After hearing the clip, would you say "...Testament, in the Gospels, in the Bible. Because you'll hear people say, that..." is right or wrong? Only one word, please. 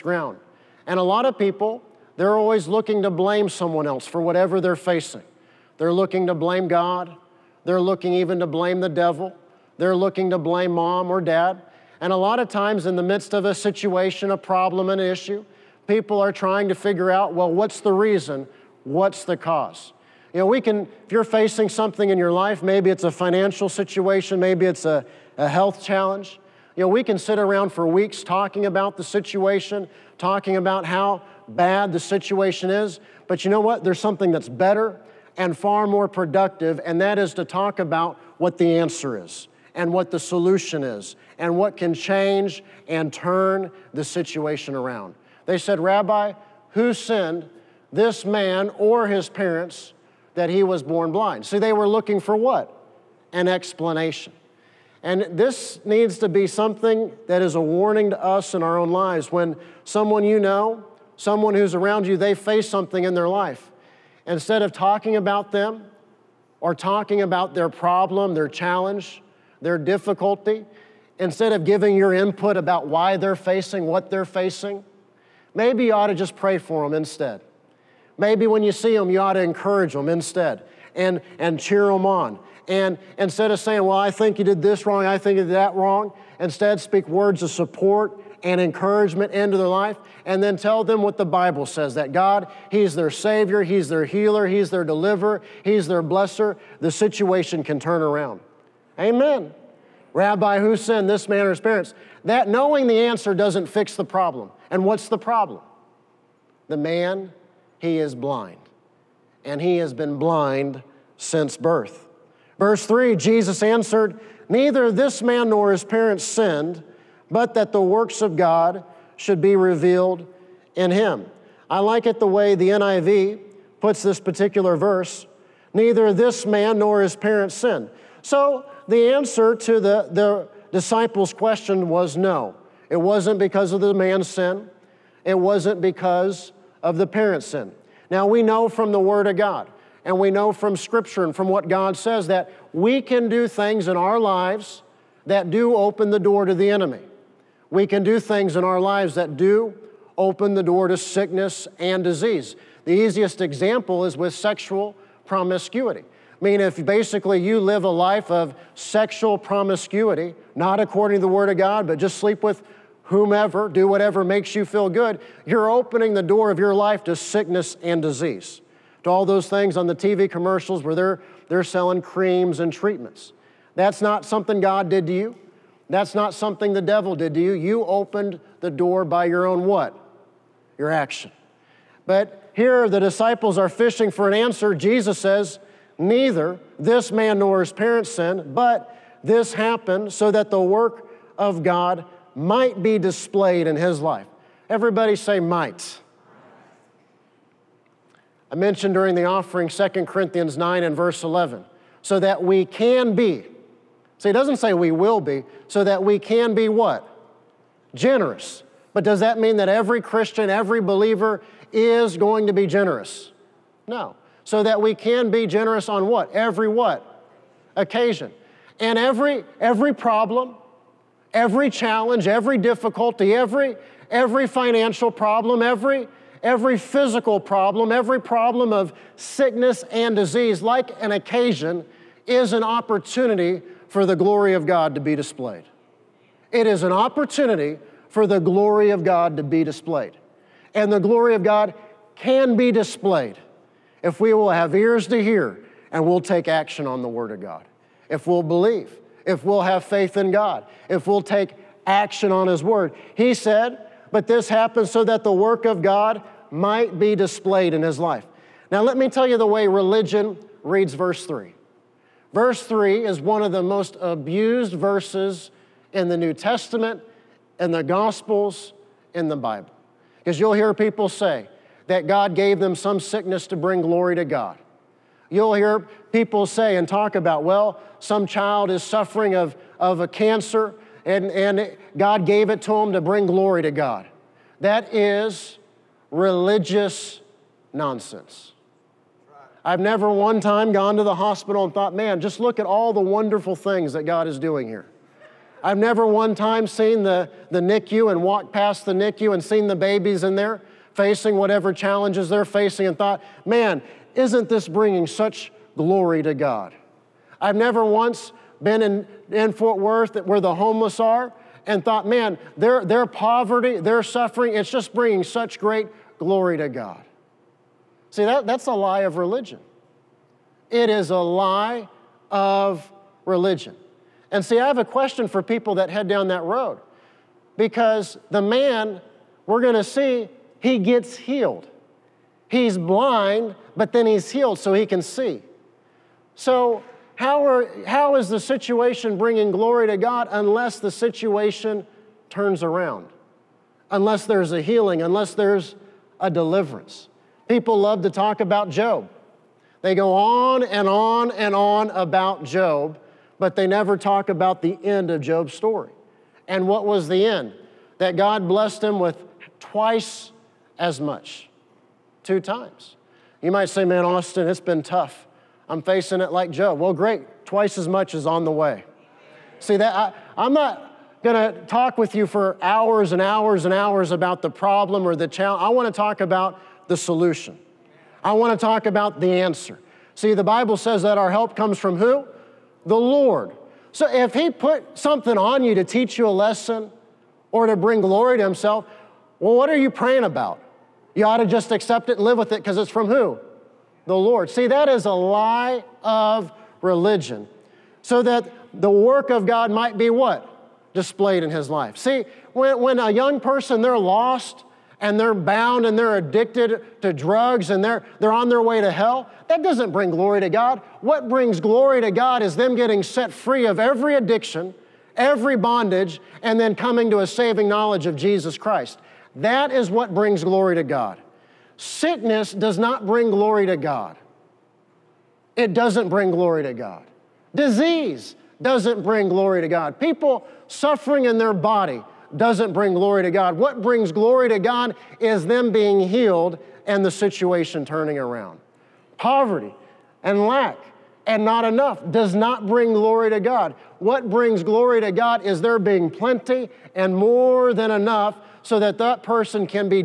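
right.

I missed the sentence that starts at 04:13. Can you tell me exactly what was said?
He said, But this happened so that the work of God might be displayed in His life.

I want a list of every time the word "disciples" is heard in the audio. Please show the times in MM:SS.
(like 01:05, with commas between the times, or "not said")
02:10, 03:02.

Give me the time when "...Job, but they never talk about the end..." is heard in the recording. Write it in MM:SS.
05:52.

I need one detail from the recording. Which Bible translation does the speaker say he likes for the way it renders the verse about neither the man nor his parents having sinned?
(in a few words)
NIV.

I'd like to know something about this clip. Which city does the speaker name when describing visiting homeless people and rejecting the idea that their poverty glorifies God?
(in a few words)
Fort Worth.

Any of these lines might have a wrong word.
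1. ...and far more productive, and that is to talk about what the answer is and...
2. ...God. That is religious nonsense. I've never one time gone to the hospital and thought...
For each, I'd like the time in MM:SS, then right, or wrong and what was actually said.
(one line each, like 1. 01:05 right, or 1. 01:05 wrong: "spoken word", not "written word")
1. 00:35 right
2. 04:43 right.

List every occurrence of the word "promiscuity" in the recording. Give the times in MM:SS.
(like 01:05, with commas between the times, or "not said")
02:35, 02:39.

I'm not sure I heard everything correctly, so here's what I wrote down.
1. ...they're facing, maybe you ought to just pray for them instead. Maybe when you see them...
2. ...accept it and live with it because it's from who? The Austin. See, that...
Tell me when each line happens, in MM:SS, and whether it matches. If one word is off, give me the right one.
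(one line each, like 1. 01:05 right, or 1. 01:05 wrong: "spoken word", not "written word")
1. 01:14 right
2. 06:31 wrong: "Lord", not "Austin".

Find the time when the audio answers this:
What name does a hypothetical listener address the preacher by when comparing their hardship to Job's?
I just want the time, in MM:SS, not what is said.
06:04.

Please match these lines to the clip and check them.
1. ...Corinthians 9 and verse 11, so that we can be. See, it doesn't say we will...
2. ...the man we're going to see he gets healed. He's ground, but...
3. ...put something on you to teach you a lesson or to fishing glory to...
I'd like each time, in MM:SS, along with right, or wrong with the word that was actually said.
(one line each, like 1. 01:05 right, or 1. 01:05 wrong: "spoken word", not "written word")
1. 03:20 right
2. 05:28 wrong: "blind", not "ground"
3. 06:24 wrong: "bring", not "fishing".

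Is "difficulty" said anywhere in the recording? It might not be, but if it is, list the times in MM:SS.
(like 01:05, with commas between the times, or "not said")
01:09, 03:42.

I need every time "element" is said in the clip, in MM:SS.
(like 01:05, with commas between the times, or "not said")
not said.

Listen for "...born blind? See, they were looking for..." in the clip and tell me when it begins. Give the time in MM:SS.
00:50.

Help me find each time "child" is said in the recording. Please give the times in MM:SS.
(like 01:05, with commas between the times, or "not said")
04:38.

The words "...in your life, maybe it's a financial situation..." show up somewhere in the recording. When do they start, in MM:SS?
00:22.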